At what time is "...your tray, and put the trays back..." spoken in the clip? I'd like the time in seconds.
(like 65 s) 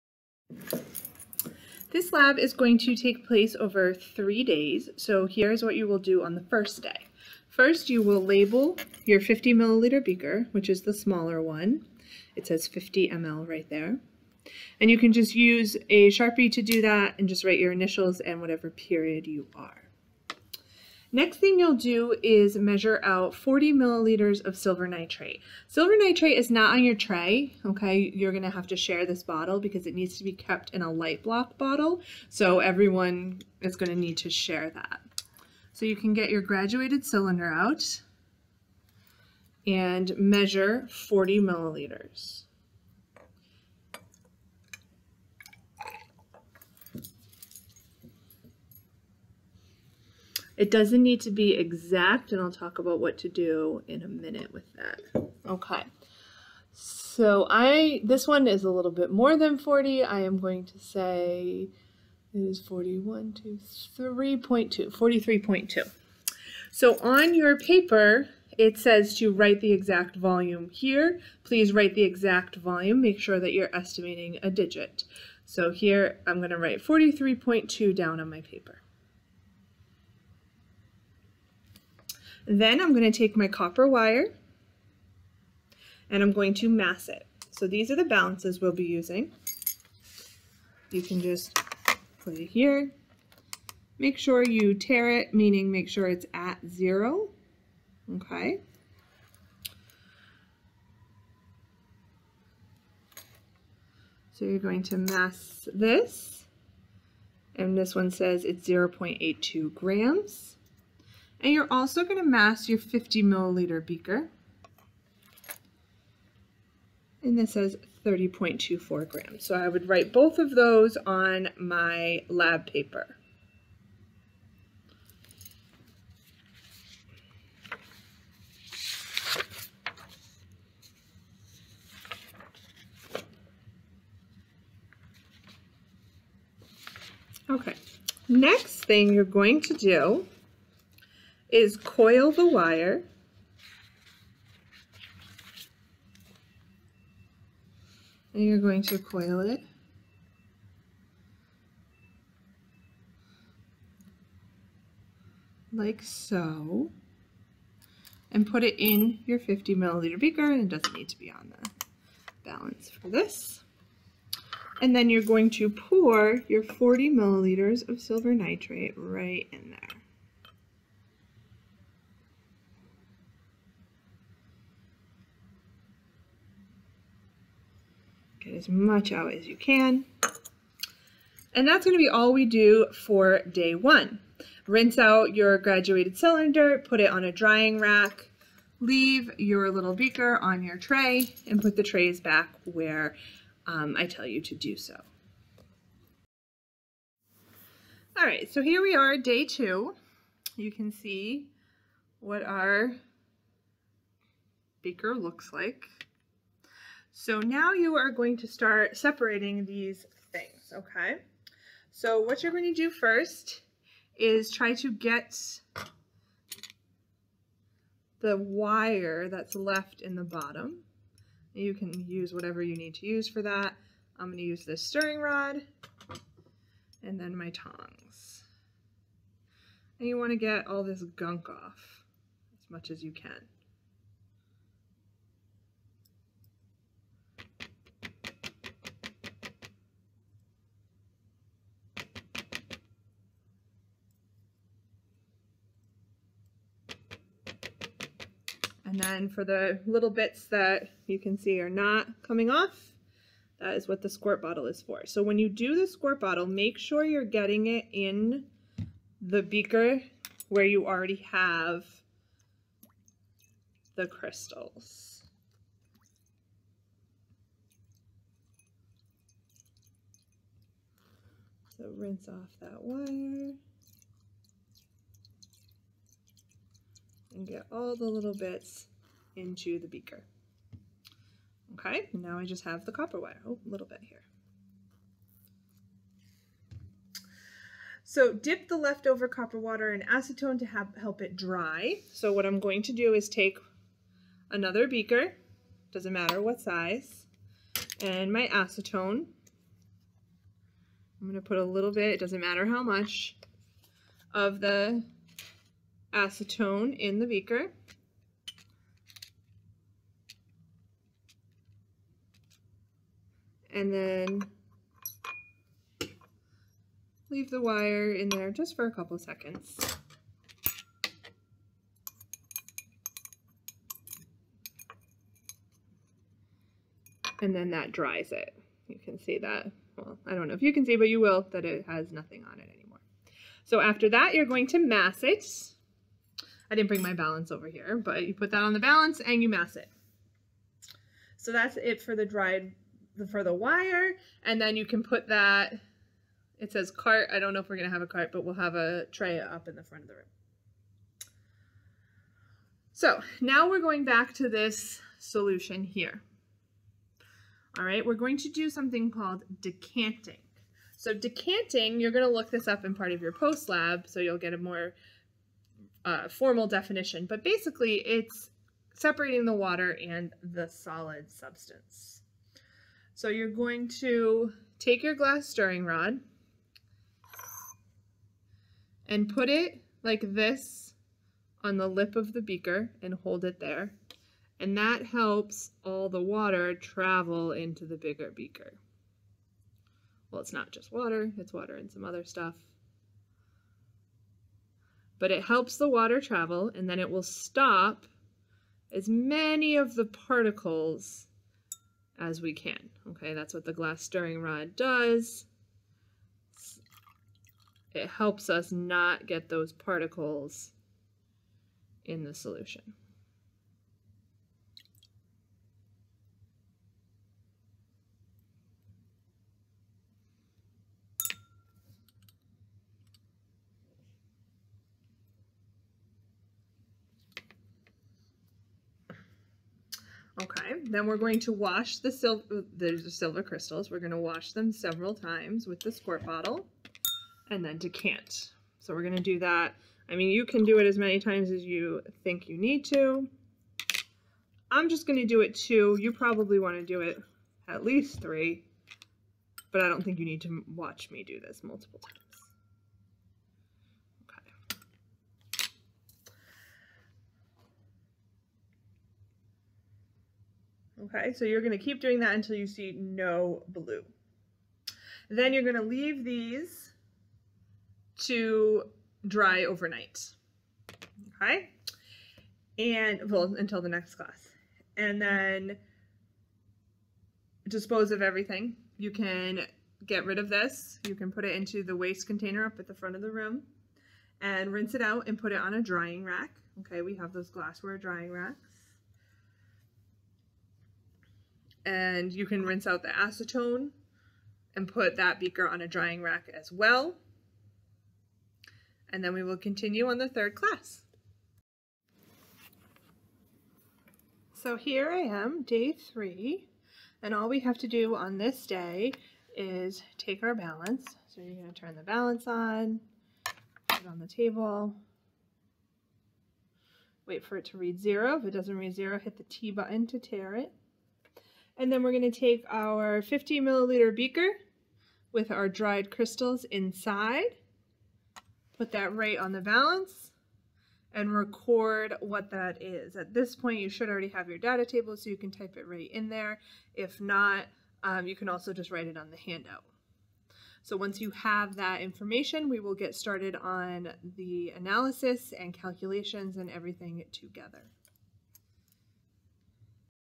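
190 s.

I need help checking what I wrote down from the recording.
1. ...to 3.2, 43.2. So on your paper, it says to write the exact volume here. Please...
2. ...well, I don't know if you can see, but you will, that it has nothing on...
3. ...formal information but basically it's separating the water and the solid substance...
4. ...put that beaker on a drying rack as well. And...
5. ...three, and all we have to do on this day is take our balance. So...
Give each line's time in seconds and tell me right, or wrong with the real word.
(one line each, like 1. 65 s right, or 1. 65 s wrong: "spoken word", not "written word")
1. 63 s right
2. 329 s right
3. 366 s wrong: "definition", not "information"
4. 494 s right
5. 505 s right.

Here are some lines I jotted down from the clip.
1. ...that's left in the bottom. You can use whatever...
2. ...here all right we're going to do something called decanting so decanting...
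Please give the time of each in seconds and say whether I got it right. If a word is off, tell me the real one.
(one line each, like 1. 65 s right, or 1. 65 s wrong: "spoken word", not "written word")
1. 219 s right
2. 355 s right.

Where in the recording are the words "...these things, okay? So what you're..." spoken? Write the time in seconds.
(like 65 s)
209 s.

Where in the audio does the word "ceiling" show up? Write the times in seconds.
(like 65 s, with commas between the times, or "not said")
not said.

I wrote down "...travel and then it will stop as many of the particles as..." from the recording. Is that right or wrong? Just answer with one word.
right.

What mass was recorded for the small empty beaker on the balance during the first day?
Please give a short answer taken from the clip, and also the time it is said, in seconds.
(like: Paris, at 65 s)
30.24 grams, at 118 s.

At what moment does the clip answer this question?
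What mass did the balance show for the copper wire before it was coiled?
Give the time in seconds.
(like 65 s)
108 s.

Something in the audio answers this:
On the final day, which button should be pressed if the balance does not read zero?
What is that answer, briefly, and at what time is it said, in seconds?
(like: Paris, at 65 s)
T button, at 519 s.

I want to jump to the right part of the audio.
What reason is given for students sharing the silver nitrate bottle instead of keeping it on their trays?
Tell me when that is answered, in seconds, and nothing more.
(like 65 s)
30 s.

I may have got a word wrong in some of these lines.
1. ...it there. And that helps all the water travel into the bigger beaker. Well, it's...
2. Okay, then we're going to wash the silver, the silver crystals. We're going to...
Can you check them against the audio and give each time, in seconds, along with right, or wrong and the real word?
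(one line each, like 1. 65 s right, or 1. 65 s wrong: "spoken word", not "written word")
1. 383 s right
2. 430 s right.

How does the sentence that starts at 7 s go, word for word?
First, you will label your 50 milliliter beaker, which is the smaller one.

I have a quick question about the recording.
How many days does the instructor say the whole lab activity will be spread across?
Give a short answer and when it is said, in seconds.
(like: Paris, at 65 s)
3, at 3 s.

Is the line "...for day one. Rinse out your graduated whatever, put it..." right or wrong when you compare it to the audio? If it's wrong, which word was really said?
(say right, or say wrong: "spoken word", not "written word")
wrong: "cylinder", not "whatever".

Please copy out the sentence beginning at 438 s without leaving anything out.
So we're going to do that.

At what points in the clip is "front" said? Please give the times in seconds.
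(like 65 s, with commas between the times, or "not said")
349 s, 482 s.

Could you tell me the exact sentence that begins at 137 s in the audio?
Okay, next thing you're going to do is coil the wire, and you're going to coil it.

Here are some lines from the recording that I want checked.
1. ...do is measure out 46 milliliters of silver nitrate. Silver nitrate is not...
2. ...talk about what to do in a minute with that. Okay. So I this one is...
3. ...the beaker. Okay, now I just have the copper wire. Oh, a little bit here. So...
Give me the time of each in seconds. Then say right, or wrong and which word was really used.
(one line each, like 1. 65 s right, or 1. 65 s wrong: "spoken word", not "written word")
1. 21 s wrong: "40", not "46"
2. 52 s right
3. 279 s right.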